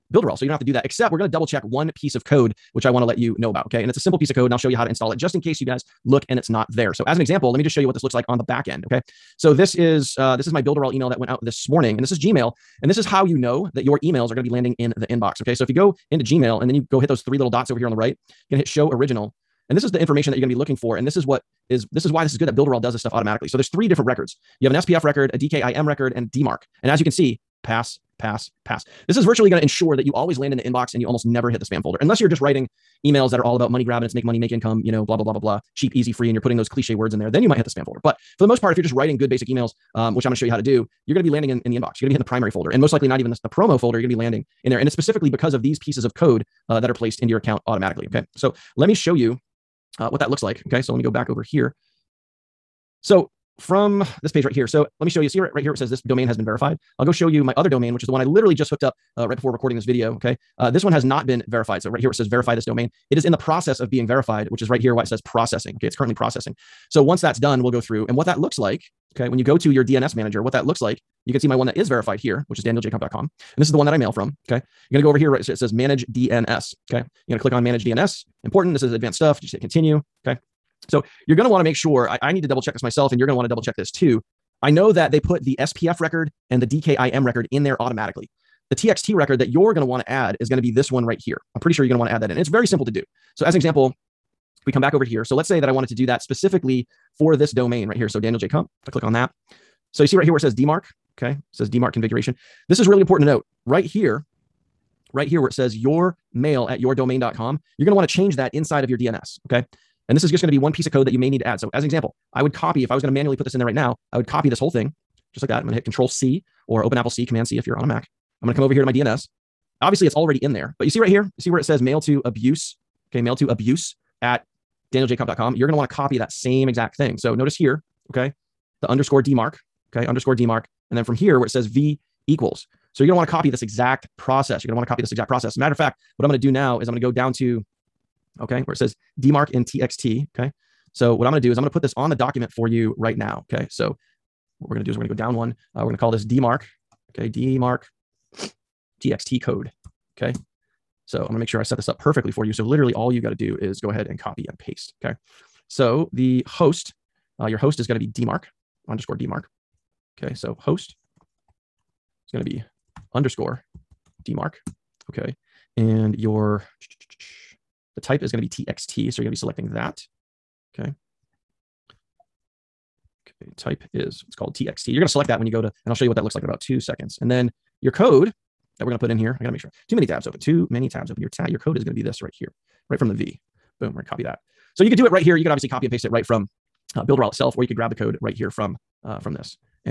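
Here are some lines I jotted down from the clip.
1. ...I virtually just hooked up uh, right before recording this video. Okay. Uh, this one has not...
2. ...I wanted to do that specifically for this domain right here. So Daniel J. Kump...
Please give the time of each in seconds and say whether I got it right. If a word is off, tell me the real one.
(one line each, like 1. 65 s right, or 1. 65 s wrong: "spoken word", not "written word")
1. 58 s wrong: "literally", not "virtually"
2. 95 s right.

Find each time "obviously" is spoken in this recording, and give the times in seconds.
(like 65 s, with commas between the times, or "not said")
119 s, 185 s.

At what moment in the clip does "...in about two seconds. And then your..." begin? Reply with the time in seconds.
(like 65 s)
176 s.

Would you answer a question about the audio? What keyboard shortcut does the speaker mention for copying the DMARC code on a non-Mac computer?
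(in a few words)
Control C.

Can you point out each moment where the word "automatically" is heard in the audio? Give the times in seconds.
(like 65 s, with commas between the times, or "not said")
23 s, 47 s, 87 s.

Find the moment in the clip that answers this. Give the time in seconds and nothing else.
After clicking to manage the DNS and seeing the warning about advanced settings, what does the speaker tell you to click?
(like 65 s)
79 s.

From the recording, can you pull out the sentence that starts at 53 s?
So from this page right here, so let me show you.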